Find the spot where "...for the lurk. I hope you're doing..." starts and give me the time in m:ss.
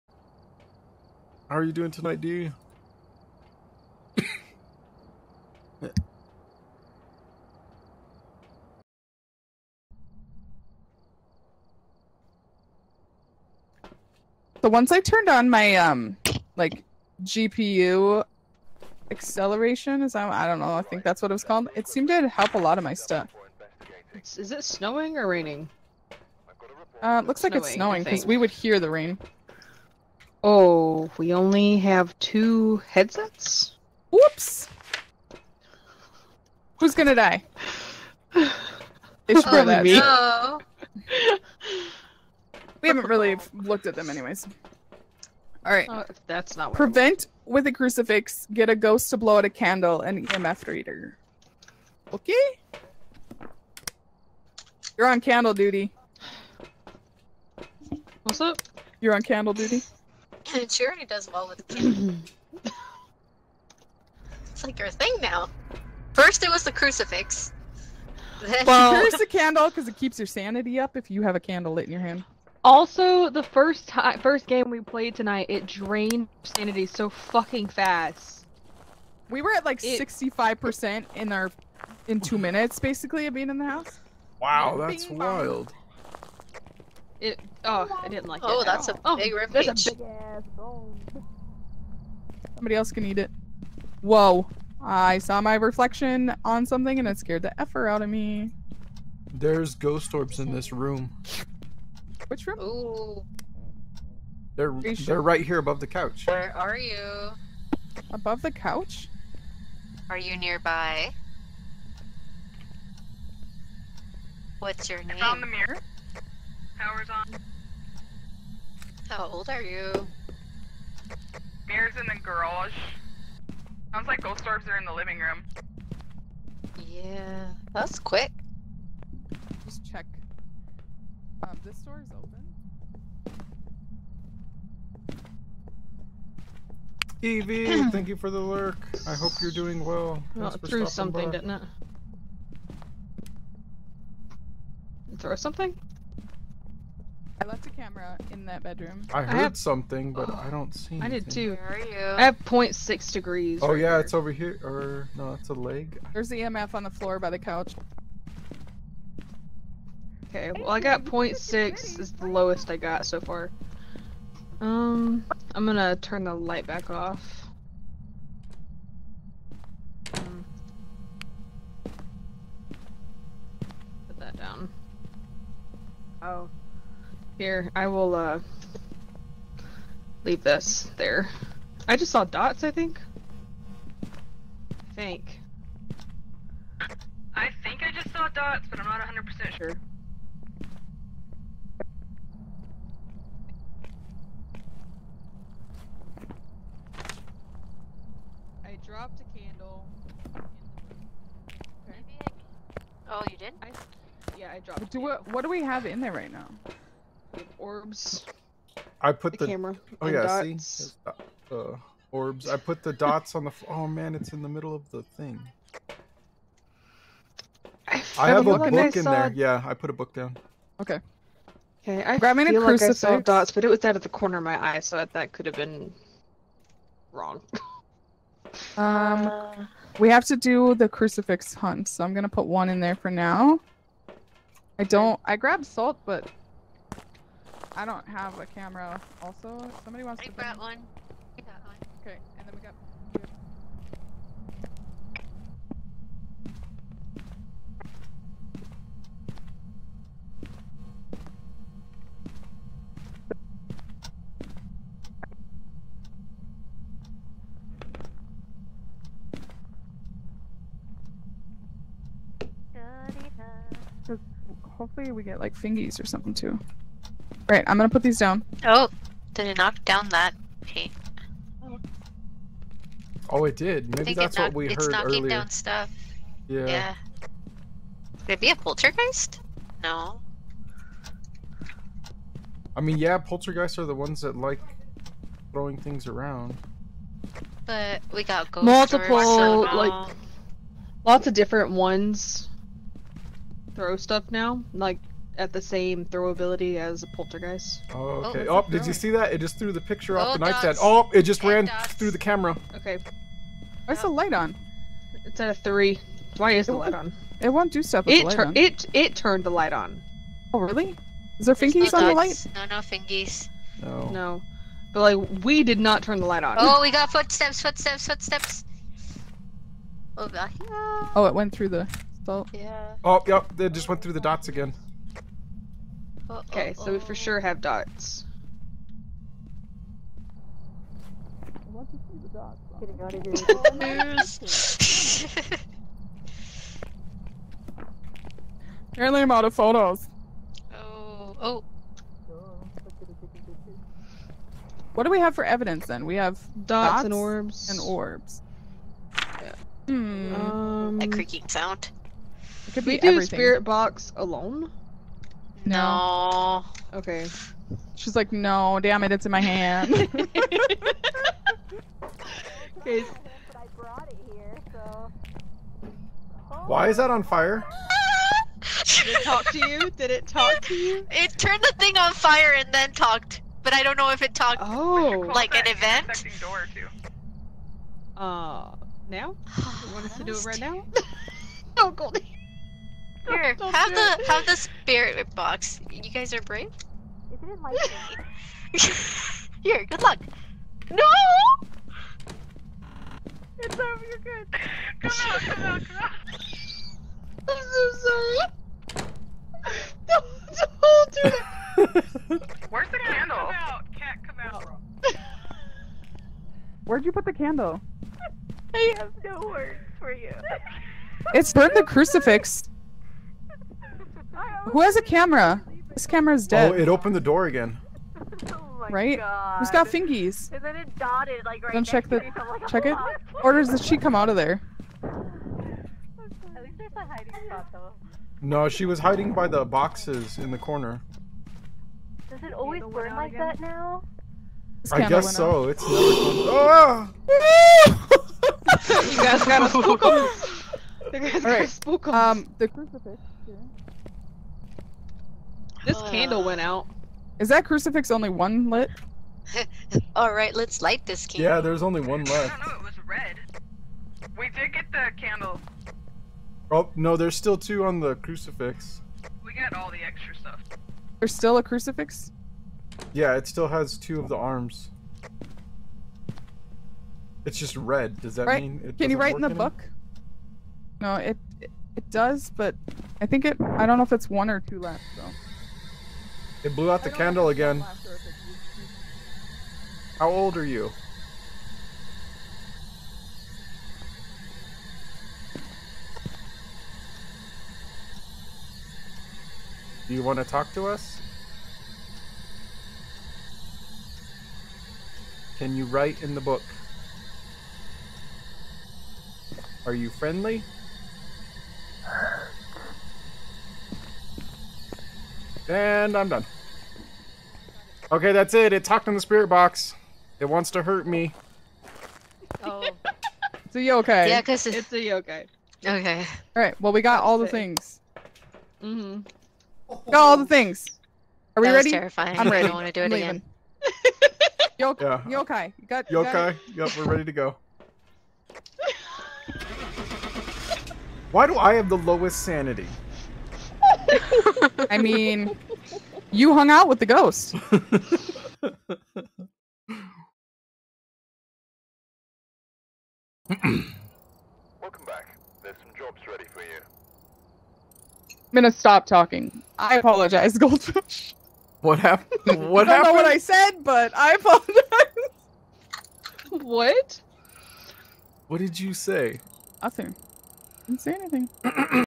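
2:18.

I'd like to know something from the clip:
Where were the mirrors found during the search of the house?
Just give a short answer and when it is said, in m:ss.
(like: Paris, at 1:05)
The garage, at 2:01.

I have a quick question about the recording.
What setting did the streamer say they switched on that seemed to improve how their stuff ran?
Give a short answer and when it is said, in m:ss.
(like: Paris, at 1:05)
GPU acceleration, at 0:17.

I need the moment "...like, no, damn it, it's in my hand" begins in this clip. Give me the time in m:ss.
5:58.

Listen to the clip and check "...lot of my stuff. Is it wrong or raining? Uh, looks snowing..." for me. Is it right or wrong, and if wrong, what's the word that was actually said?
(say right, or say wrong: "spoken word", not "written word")
wrong: "snowing", not "wrong".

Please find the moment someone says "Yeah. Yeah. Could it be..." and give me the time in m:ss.
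4:36.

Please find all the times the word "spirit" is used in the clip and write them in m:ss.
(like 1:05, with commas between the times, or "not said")
5:53, 6:24, 8:29.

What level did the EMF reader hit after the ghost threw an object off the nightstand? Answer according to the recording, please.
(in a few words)
3.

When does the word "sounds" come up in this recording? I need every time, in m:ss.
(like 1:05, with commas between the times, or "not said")
2:03, 5:51.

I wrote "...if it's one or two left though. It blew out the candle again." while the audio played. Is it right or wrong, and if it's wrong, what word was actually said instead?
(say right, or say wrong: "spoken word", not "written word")
right.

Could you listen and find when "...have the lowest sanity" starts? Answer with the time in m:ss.
8:51.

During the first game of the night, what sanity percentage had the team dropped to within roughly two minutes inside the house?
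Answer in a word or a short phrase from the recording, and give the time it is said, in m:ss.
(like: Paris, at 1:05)
65%, at 1:19.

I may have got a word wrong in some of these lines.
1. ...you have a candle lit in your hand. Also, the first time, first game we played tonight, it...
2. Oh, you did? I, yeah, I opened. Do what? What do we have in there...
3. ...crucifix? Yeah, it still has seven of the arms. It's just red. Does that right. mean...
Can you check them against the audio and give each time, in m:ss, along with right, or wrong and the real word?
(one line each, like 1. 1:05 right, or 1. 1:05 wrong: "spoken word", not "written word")
1. 1:11 right
2. 3:23 wrong: "dropped", not "opened"
3. 7:41 wrong: "two", not "seven".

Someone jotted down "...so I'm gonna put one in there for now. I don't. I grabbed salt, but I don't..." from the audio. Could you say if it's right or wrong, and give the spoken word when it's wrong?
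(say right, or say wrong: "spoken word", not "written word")
right.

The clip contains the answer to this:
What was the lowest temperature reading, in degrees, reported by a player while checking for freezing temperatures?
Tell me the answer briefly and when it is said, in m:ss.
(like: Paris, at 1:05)
0.6, at 2:32.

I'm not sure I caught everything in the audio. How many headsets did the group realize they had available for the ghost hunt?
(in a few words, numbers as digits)
2.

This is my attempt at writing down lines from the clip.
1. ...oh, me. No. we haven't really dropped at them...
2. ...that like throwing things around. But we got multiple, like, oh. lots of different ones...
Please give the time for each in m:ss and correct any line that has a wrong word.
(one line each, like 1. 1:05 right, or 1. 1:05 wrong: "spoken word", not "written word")
1. 0:39 wrong: "looked", not "dropped"
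2. 4:44 right.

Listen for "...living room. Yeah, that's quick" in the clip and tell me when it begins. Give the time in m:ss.
2:04.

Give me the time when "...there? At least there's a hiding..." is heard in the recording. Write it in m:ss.
7:04.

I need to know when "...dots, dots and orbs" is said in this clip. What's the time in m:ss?
5:46.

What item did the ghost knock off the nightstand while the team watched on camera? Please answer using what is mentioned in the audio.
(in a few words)
The picture.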